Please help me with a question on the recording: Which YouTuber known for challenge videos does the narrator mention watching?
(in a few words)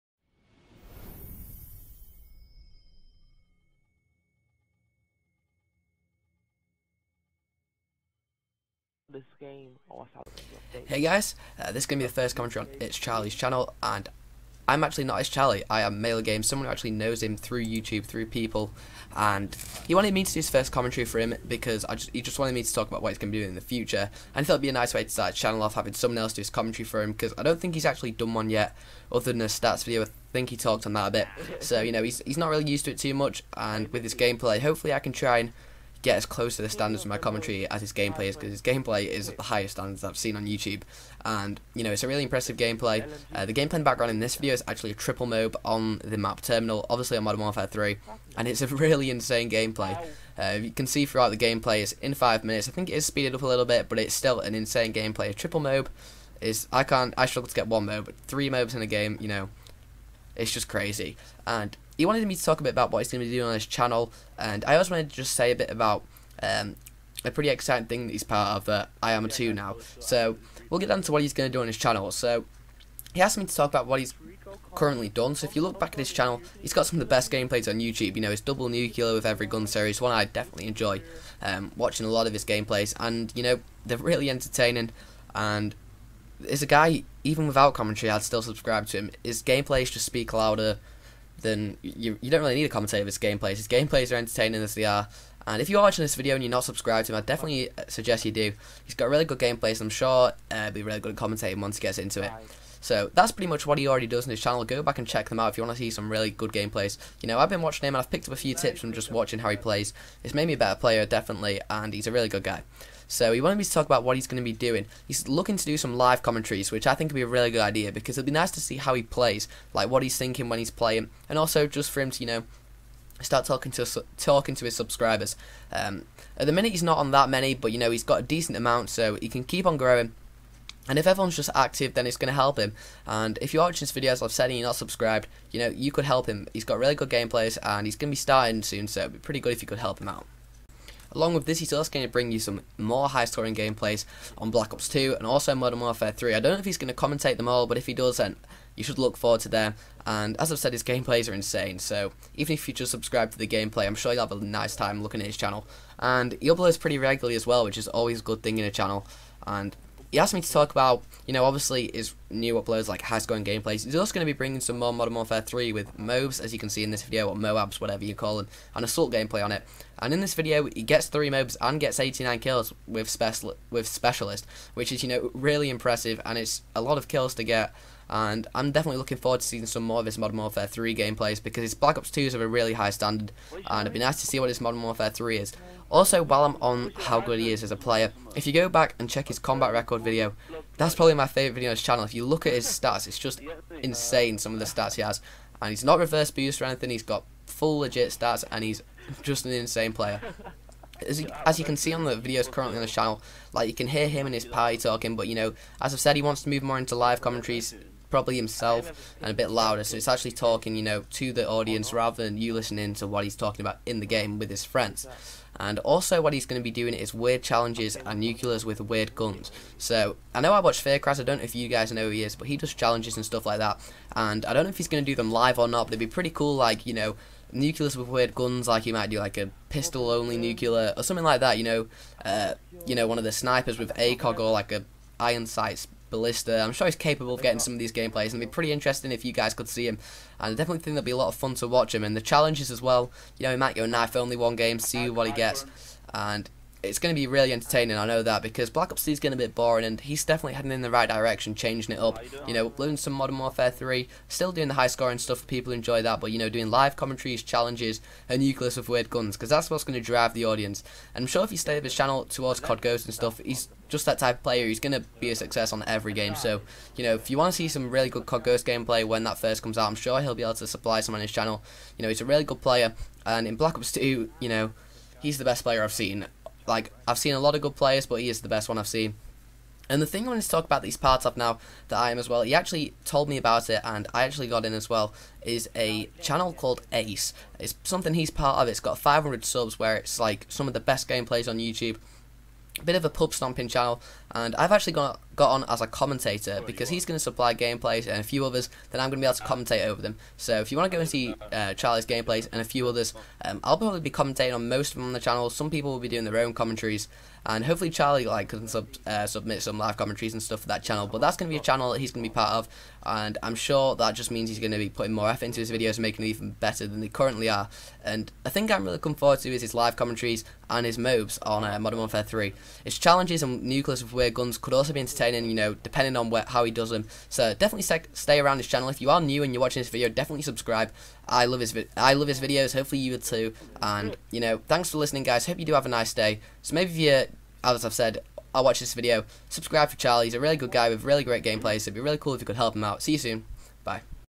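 Faircrass.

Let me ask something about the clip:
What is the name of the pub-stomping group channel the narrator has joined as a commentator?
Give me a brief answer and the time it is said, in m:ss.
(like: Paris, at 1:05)
Ace, at 4:46.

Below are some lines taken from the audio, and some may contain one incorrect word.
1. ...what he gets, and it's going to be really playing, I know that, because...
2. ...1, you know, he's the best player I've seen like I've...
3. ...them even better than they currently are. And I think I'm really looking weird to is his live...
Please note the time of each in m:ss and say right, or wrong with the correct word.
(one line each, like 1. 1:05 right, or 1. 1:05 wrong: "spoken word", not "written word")
1. 4:05 wrong: "entertaining", not "playing"
2. 4:33 wrong: "2", not "1"
3. 5:16 wrong: "forward", not "weird".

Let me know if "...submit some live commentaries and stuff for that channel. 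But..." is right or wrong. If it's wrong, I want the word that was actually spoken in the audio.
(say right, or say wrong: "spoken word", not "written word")
right.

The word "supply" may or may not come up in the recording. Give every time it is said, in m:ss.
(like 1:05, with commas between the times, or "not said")
4:30, 4:57.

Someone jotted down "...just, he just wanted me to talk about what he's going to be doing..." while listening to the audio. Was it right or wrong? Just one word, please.
right.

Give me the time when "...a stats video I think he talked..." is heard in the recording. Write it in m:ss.
0:29.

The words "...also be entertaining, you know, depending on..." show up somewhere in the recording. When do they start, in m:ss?
5:24.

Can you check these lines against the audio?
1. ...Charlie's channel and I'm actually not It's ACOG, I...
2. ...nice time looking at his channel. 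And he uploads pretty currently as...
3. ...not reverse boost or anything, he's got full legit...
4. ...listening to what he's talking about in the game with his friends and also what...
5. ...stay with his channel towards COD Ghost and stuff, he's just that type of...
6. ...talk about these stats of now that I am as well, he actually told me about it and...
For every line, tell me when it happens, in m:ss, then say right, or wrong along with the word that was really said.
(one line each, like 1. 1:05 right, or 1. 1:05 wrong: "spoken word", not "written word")
1. 0:12 wrong: "Charlie", not "ACOG"
2. 2:34 wrong: "regularly", not "currently"
3. 3:15 right
4. 3:32 right
5. 4:21 right
6. 4:40 wrong: "parts", not "stats".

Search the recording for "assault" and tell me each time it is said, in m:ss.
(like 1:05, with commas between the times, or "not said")
2:48.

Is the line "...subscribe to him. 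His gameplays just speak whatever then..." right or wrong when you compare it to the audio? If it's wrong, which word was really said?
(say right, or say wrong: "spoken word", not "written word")
wrong: "louder", not "whatever".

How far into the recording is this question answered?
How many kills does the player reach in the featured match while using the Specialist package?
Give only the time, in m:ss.
2:51.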